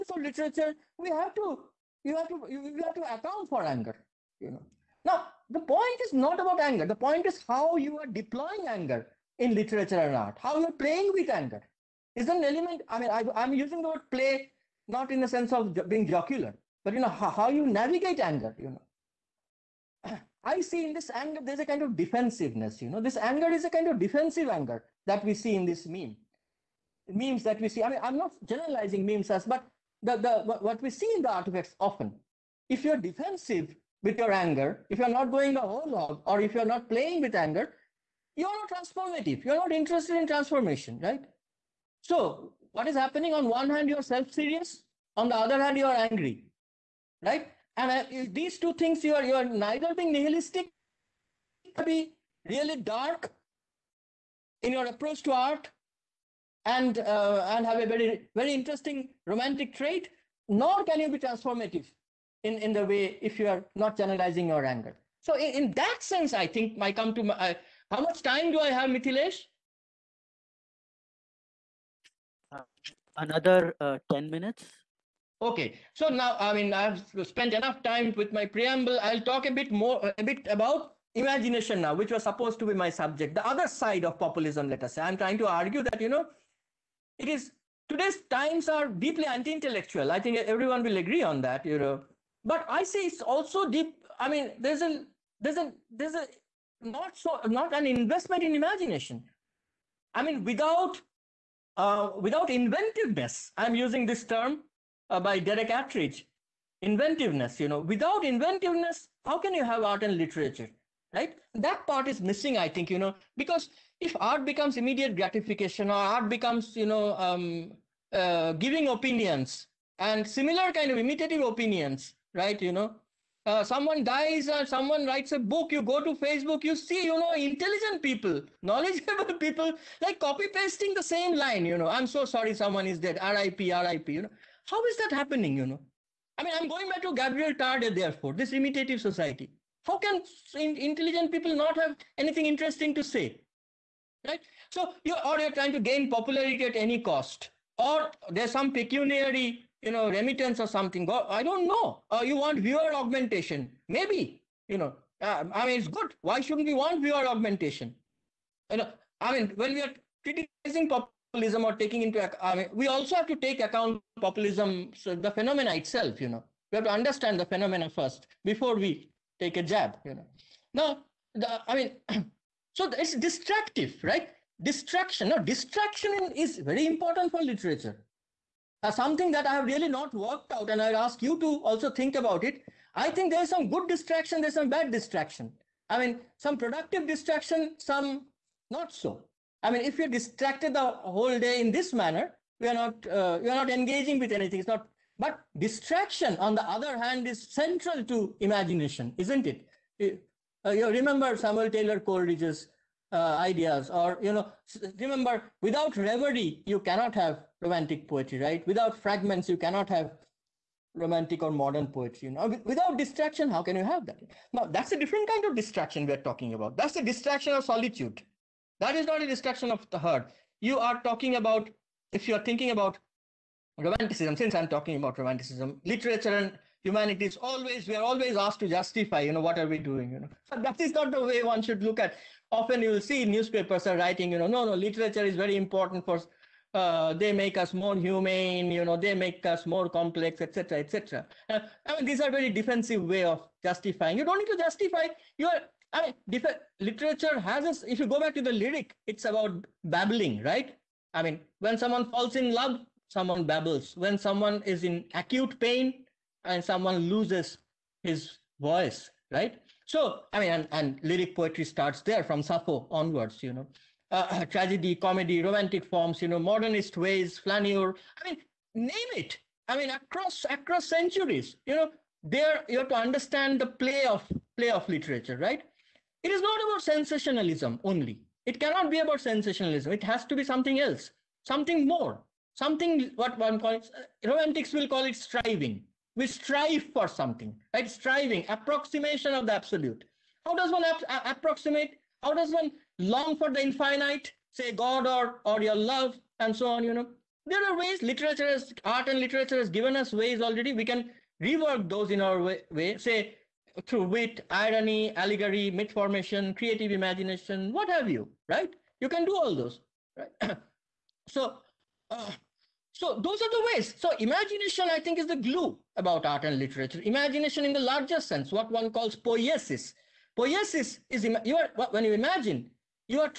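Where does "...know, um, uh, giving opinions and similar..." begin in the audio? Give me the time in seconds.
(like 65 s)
116 s.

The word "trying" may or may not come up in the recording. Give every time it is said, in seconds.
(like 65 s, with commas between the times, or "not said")
85 s, 145 s.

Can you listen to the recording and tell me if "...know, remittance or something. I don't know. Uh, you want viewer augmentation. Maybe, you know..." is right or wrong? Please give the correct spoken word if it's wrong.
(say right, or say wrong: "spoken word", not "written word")
right.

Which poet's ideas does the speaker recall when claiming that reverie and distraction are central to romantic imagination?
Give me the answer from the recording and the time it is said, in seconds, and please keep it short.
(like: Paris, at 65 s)
Samuel Taylor Coleridge, at 201 s.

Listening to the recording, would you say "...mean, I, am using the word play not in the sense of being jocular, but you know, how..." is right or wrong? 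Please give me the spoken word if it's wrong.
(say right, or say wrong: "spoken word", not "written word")
right.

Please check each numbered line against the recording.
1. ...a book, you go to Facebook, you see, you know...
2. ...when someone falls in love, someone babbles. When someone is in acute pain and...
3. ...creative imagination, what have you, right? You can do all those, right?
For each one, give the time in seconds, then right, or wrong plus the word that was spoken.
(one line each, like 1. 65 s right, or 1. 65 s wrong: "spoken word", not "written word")
1. 125 s right
2. 251 s right
3. 306 s right.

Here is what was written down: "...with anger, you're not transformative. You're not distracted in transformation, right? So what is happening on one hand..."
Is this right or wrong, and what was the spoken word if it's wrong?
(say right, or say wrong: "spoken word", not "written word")
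wrong: "interested", not "distracted".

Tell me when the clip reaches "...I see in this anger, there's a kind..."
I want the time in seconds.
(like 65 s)
20 s.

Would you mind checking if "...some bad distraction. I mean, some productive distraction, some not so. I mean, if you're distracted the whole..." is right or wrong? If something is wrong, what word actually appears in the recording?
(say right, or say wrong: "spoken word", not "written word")
right.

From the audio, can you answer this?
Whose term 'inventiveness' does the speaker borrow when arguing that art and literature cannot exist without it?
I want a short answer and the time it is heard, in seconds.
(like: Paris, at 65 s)
Derek Attridge, at 105 s.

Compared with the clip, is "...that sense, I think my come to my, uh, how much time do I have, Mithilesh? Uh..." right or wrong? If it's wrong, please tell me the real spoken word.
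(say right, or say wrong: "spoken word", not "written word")
right.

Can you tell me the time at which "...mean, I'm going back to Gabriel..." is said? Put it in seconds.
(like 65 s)
136 s.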